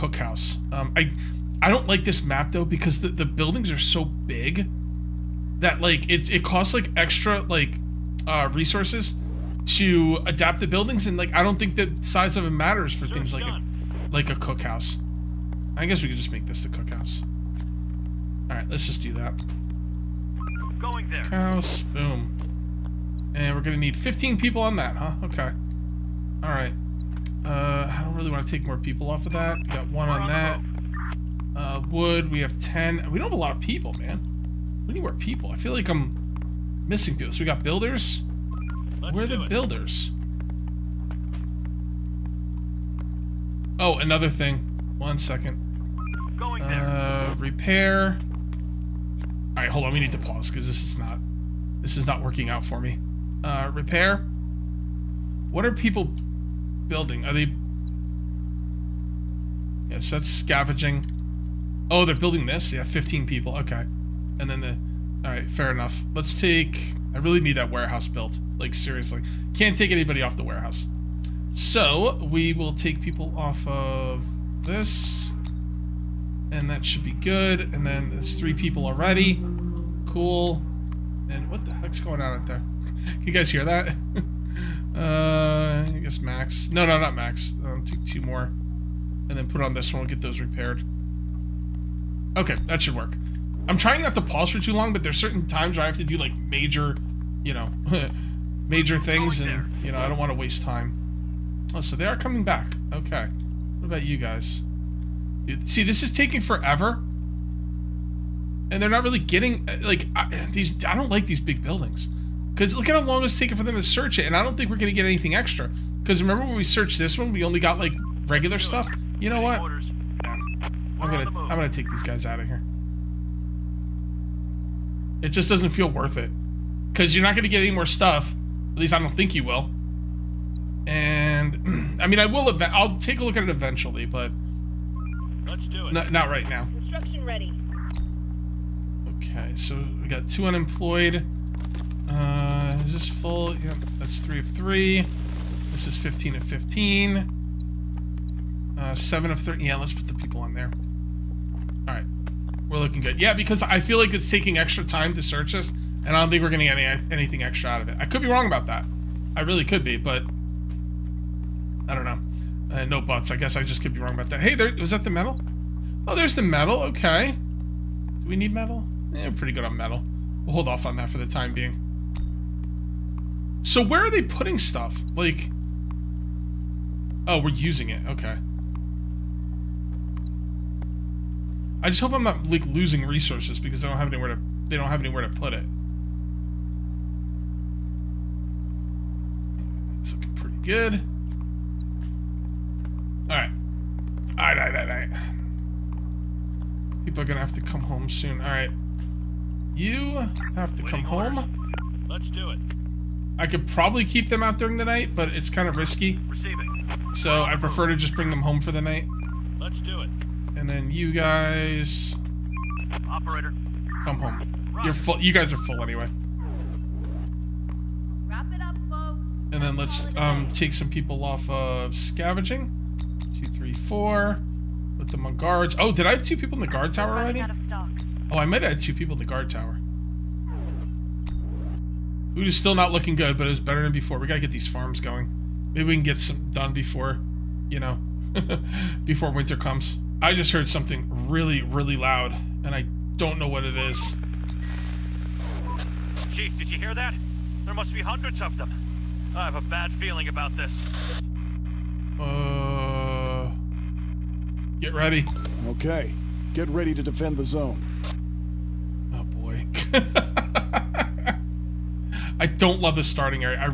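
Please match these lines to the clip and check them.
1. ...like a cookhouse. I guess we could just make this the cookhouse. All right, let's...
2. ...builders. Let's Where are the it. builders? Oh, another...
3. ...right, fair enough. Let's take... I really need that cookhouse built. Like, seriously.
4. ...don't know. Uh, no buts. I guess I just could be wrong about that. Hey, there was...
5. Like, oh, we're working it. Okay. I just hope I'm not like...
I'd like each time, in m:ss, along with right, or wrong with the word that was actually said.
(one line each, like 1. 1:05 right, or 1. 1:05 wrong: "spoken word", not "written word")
1. 0:14 right
2. 0:37 right
3. 1:05 wrong: "warehouse", not "cookhouse"
4. 2:41 right
5. 2:55 wrong: "using", not "working".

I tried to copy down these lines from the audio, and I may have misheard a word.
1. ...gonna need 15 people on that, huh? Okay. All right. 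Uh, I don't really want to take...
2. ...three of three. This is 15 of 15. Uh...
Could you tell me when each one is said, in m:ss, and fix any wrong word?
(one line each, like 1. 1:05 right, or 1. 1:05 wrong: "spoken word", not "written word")
1. 0:23 right
2. 2:24 right.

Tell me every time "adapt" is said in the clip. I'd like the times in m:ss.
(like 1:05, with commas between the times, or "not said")
0:10.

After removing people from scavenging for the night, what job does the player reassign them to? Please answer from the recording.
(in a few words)
Guards.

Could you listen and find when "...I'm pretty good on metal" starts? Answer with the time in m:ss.
2:49.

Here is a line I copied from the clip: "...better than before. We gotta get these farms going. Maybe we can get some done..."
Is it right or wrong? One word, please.
right.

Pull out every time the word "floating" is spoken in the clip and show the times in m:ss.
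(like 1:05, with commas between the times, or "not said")
not said.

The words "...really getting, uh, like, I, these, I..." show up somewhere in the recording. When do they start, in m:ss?
1:49.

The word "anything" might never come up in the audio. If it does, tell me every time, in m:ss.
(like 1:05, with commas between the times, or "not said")
1:55, 2:37.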